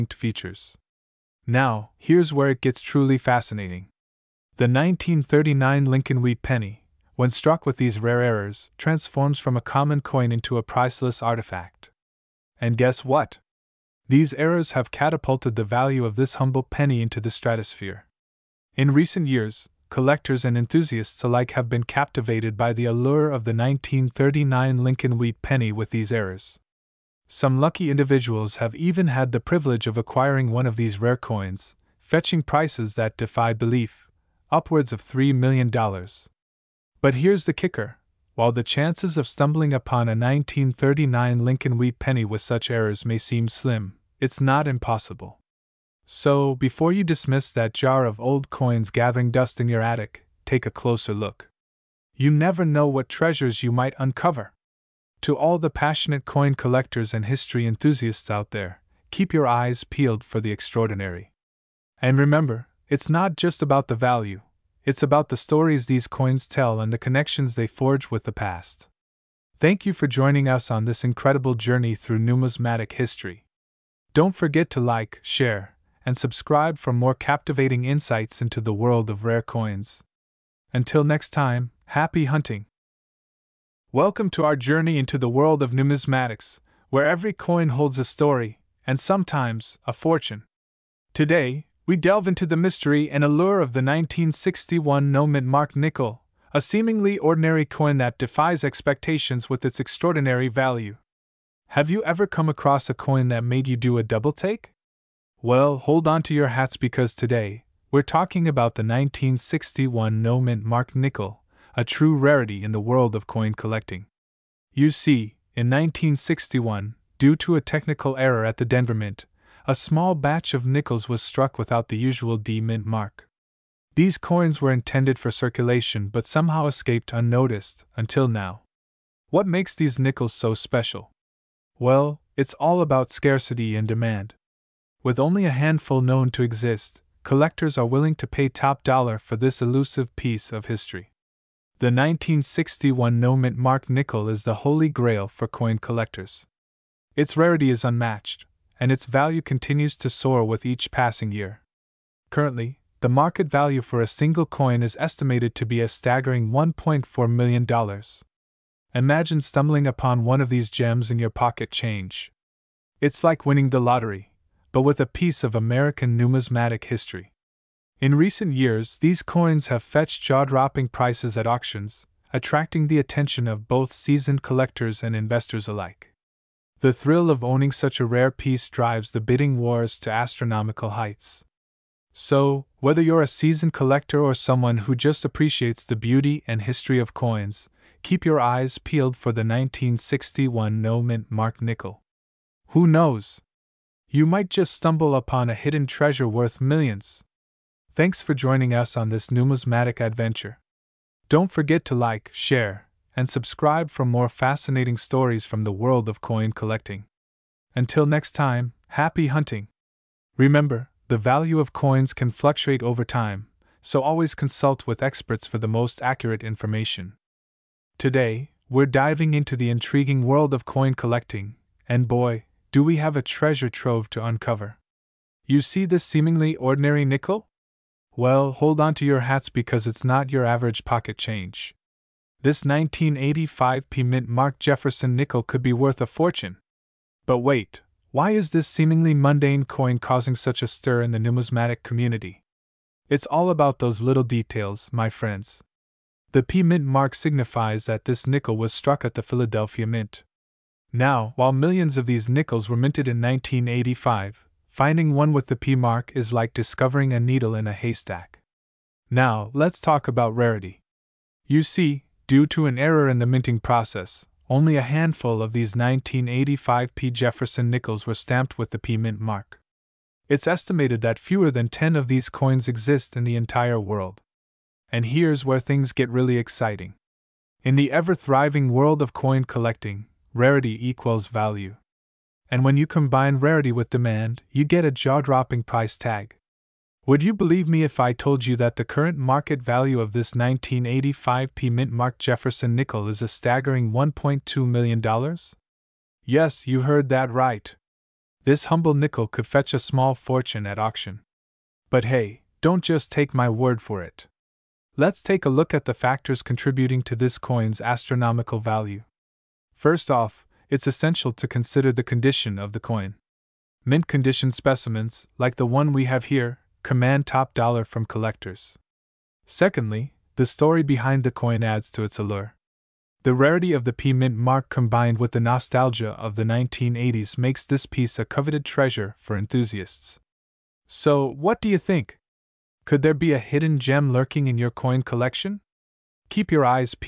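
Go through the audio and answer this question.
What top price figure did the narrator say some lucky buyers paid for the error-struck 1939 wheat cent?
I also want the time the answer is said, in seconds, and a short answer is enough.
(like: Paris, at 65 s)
$3 million, at 35 s.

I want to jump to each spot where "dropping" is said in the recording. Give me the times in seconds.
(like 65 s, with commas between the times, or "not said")
170 s, 285 s.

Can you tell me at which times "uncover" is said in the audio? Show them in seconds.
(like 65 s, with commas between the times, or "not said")
53 s, 224 s.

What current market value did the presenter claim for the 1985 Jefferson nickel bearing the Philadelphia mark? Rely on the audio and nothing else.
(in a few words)
$1.2 million.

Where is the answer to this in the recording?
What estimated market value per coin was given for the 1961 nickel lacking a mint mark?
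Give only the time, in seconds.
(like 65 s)
156 s.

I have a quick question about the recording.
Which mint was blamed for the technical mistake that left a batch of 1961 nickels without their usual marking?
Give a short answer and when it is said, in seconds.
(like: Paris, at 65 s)
Denver Mint, at 118 s.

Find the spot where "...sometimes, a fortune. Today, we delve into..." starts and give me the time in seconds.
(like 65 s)
88 s.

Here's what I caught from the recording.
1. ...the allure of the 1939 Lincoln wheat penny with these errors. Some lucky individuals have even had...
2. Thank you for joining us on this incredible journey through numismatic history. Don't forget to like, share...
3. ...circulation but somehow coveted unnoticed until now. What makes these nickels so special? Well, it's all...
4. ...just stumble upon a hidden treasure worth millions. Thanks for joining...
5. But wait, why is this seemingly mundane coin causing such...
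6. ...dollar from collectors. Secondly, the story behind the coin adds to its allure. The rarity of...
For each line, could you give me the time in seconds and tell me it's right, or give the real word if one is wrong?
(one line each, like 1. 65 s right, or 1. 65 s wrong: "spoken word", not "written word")
1. 22 s right
2. 69 s right
3. 125 s wrong: "escaped", not "coveted"
4. 194 s right
5. 237 s right
6. 317 s right.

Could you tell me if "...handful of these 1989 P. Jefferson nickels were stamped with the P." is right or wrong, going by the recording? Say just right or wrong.
wrong.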